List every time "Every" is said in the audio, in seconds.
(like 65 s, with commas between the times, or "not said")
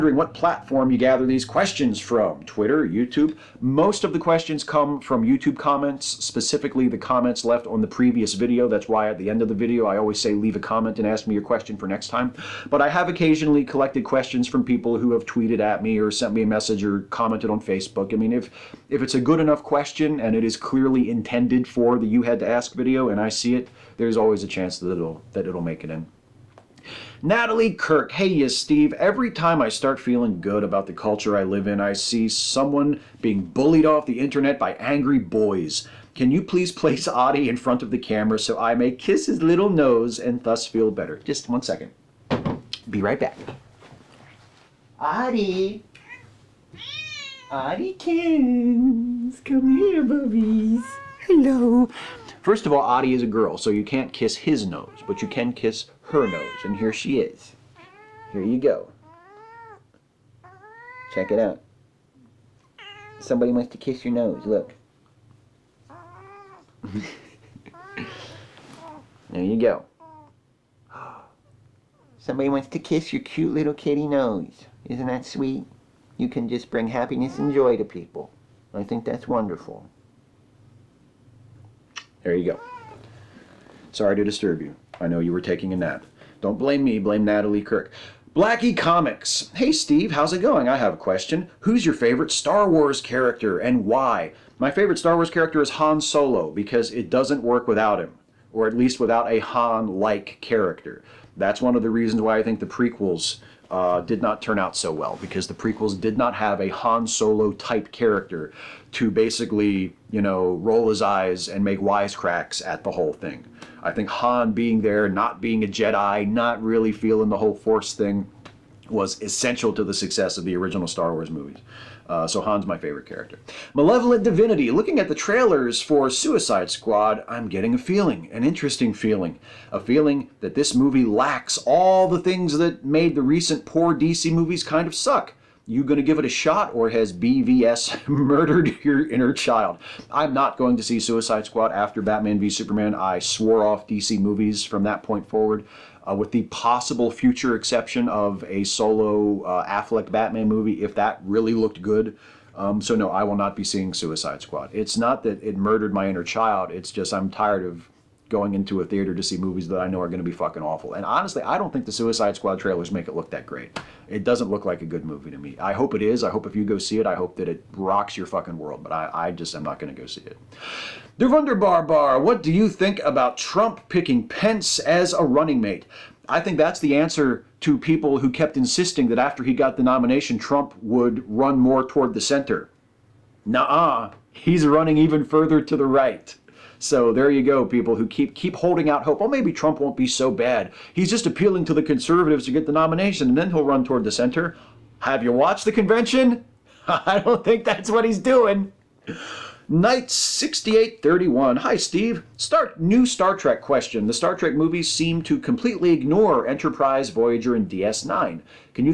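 28 s.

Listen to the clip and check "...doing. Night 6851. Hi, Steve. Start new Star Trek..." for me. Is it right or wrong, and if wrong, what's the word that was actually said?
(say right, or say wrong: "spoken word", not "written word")
wrong: "6831", not "6851".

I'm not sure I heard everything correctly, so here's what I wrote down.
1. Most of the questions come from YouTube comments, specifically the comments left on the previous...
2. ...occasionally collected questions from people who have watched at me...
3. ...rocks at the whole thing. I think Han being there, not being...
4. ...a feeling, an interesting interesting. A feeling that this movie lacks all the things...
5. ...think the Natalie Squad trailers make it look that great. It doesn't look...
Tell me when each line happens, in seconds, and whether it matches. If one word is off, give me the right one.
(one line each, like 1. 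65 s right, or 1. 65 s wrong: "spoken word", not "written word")
1. 3 s right
2. 13 s wrong: "tweeted", not "watched"
3. 111 s wrong: "wisecracks", not "rocks"
4. 127 s wrong: "feeling", not "interesting"
5. 161 s wrong: "Suicide", not "Natalie".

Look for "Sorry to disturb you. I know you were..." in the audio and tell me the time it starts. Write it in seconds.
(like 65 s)
83 s.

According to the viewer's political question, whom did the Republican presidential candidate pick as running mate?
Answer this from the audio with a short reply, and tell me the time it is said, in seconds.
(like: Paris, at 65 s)
Pence, at 174 s.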